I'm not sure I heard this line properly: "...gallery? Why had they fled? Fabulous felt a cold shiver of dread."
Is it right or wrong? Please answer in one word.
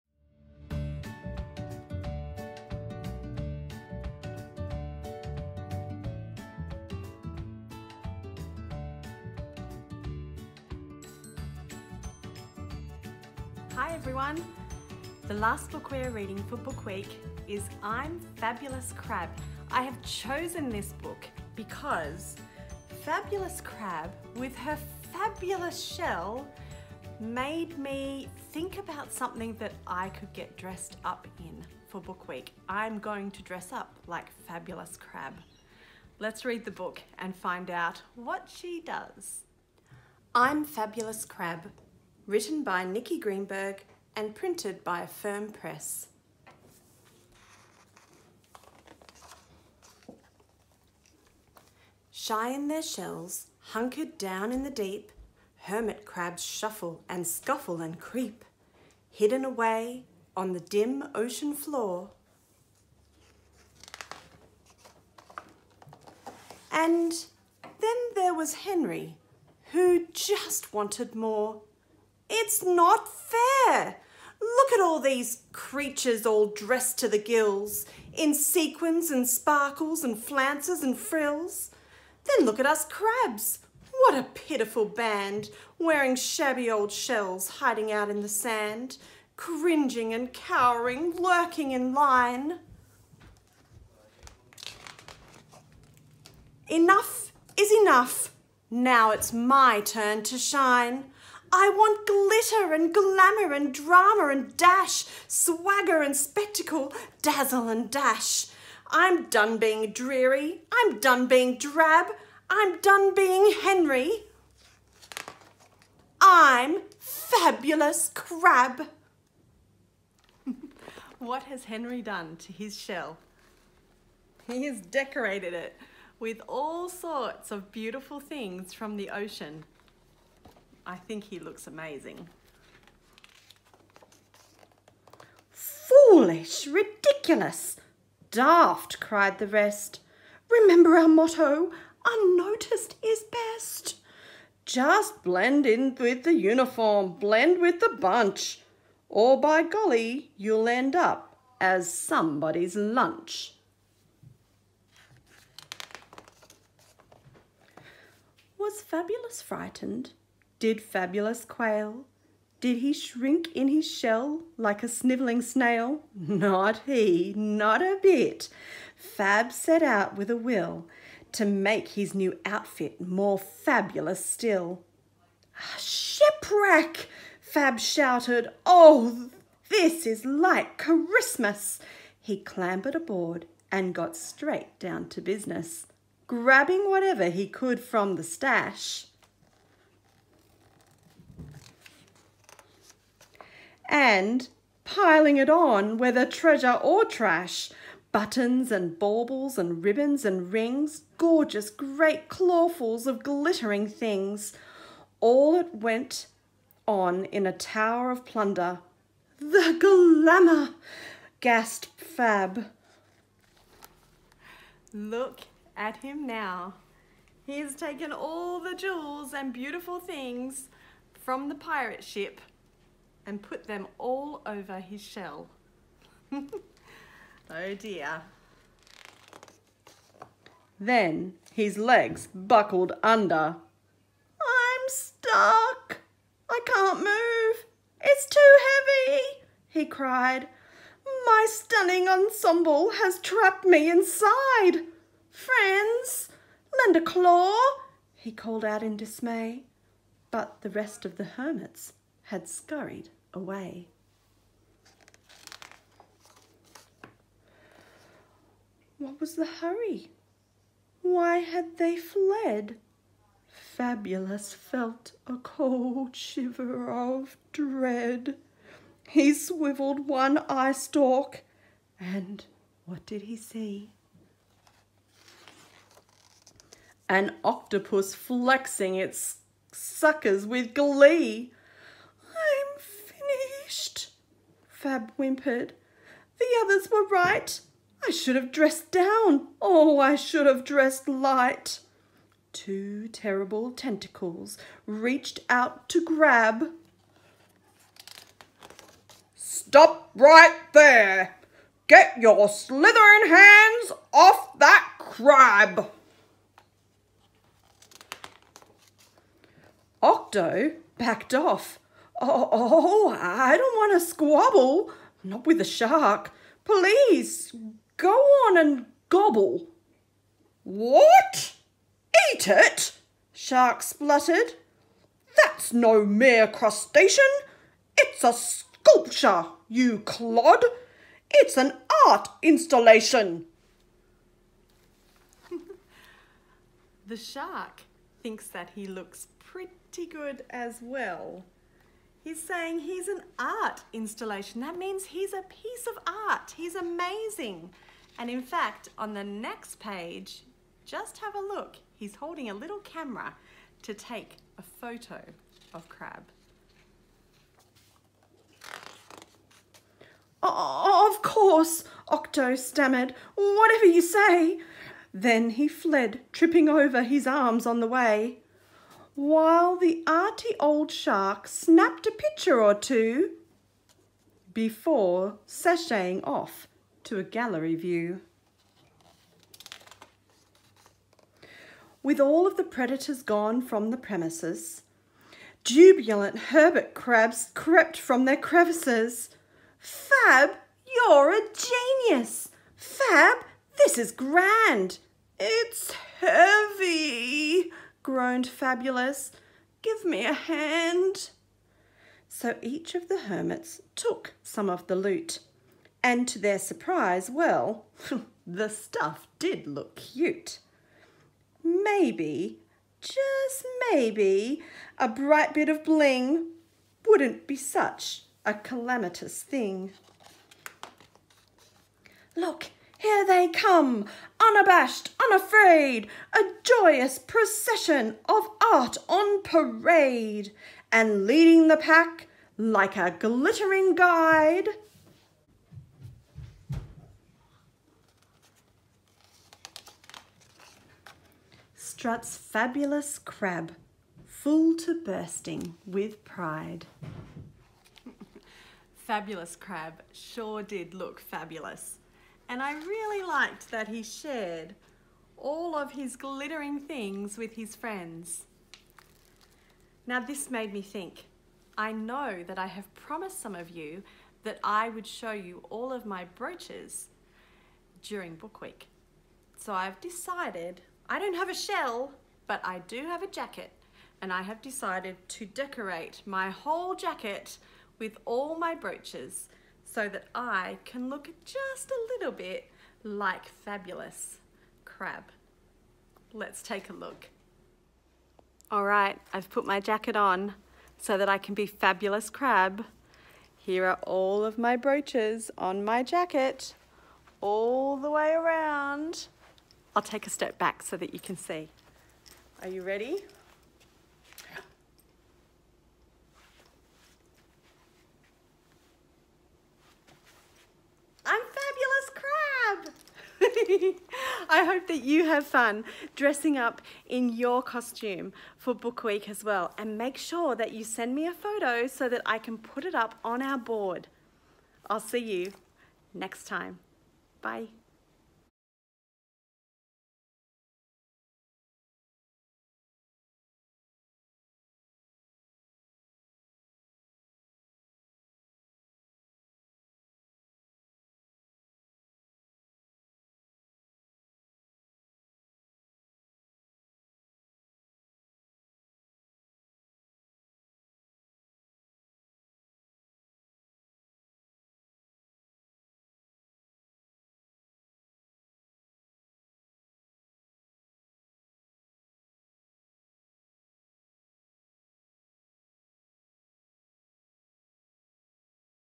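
wrong.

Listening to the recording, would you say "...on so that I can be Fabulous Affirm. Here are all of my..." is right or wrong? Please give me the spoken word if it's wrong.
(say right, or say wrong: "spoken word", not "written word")
wrong: "Crab", not "Affirm".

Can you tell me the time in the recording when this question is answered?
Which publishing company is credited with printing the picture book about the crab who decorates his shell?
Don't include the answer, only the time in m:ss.
0:45.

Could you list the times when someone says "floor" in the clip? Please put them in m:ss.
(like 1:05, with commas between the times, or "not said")
1:01.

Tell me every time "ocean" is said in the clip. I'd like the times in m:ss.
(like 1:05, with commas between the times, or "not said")
1:01, 2:09.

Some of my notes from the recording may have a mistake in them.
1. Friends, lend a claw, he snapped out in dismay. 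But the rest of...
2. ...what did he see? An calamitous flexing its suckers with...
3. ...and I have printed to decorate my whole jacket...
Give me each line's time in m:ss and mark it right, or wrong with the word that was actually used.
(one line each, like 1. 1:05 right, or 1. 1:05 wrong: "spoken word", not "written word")
1. 4:05 wrong: "called", not "snapped"
2. 4:32 wrong: "octopus", not "calamitous"
3. 7:54 wrong: "decided", not "printed".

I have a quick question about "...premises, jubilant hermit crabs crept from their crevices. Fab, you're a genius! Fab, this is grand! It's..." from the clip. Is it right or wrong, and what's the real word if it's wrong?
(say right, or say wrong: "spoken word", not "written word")
right.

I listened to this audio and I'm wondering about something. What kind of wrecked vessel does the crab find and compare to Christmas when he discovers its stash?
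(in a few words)
Shipwreck.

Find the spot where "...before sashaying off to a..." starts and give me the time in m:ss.
6:14.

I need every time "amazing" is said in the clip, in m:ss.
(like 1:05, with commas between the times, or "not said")
2:11, 5:46.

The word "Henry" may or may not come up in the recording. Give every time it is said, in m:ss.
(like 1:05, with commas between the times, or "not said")
1:08, 1:53, 2:01.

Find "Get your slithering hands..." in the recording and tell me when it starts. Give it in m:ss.
5:01.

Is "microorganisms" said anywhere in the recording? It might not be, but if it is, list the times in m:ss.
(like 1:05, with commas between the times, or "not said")
not said.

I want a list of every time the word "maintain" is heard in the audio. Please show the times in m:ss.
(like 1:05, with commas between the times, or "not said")
not said.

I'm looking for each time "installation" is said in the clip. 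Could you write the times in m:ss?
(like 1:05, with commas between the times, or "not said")
5:32, 5:43.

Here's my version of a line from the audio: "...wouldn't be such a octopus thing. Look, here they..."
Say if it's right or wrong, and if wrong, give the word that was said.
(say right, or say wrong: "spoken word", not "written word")
wrong: "calamitous", not "octopus".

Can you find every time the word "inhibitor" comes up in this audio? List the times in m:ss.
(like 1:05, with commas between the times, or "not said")
not said.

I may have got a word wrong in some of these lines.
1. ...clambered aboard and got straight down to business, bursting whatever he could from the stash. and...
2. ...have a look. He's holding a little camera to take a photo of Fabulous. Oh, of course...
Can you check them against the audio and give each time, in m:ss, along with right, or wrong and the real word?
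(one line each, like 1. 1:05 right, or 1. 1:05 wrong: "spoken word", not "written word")
1. 3:02 wrong: "grabbing", not "bursting"
2. 5:51 wrong: "Crab", not "Fabulous".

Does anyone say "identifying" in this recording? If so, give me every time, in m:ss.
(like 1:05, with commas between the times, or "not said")
not said.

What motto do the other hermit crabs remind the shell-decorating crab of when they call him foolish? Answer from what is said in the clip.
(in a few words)
Unnoticed is best.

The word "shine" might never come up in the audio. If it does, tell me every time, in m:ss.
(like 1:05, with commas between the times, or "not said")
1:40.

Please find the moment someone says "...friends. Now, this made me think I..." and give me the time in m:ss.
7:37.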